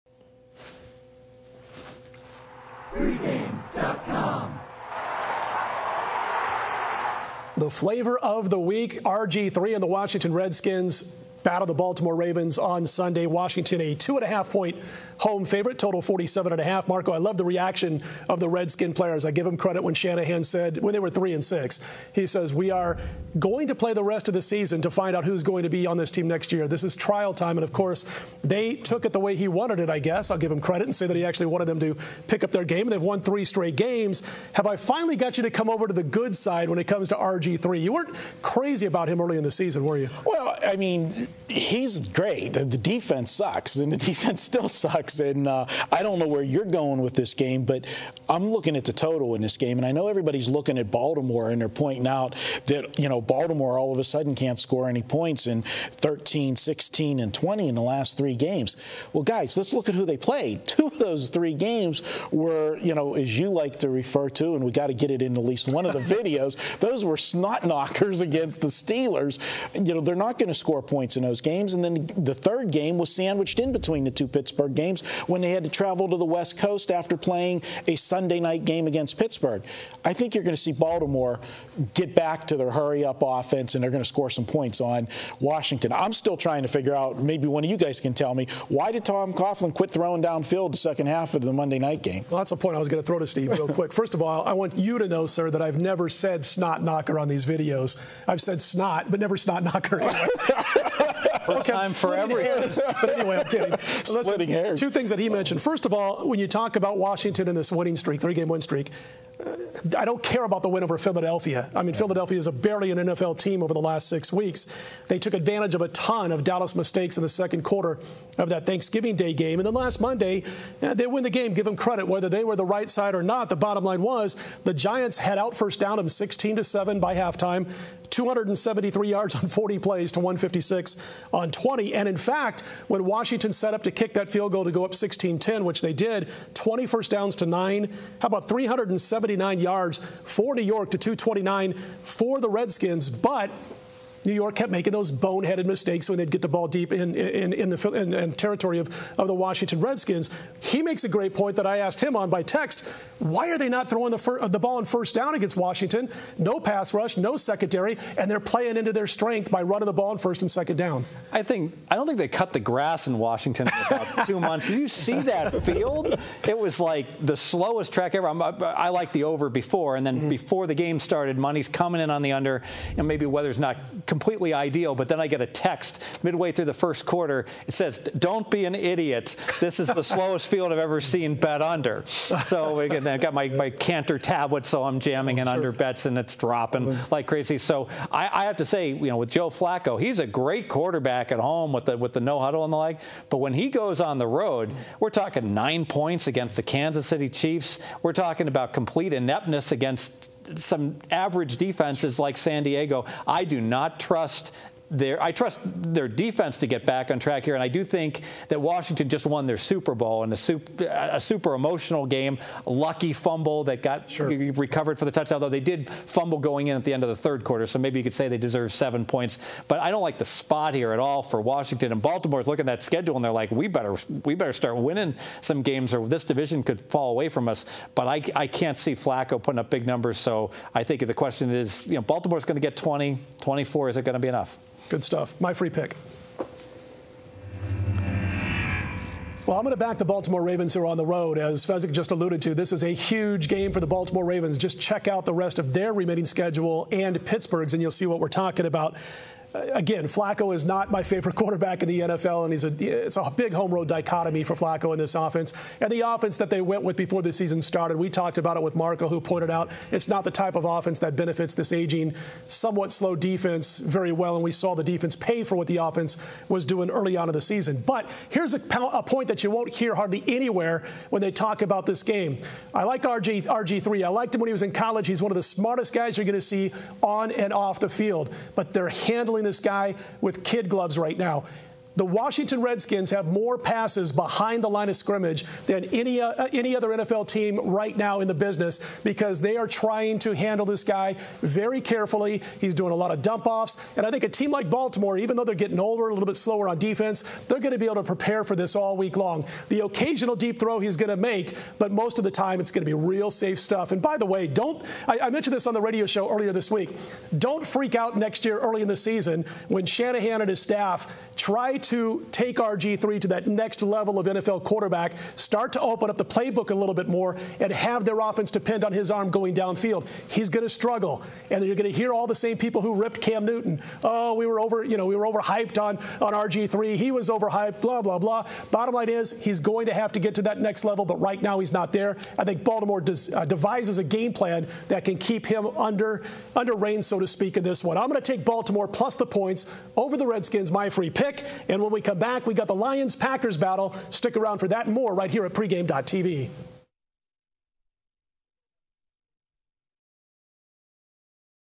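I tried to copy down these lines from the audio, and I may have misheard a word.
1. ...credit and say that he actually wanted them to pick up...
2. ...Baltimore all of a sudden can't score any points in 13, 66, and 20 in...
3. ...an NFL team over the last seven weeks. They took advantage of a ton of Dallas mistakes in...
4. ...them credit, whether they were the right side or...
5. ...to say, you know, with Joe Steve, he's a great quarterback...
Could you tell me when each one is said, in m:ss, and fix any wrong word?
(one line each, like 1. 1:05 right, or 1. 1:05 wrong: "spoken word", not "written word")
1. 0:30 right
2. 0:53 wrong: "16", not "66"
3. 1:52 wrong: "six", not "seven"
4. 2:01 right
5. 3:08 wrong: "Flacco", not "Steve".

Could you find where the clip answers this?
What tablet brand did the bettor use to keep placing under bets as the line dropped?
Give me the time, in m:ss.
3:03.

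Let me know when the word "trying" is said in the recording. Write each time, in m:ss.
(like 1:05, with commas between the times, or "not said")
1:26, 4:49.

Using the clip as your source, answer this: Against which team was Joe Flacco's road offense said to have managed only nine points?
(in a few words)
Kansas City Chiefs.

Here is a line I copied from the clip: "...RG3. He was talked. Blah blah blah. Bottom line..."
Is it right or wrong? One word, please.
wrong.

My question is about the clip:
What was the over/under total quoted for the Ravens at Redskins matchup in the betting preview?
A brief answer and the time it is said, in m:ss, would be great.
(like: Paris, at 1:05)
47.5, at 0:15.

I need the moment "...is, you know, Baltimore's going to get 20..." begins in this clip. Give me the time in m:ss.
3:51.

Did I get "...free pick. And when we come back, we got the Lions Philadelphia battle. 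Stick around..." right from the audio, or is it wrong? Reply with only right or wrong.
wrong.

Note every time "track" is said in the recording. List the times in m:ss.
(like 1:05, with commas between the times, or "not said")
2:47, 3:27.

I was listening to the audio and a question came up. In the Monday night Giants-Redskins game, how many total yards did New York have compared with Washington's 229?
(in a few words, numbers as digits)
379.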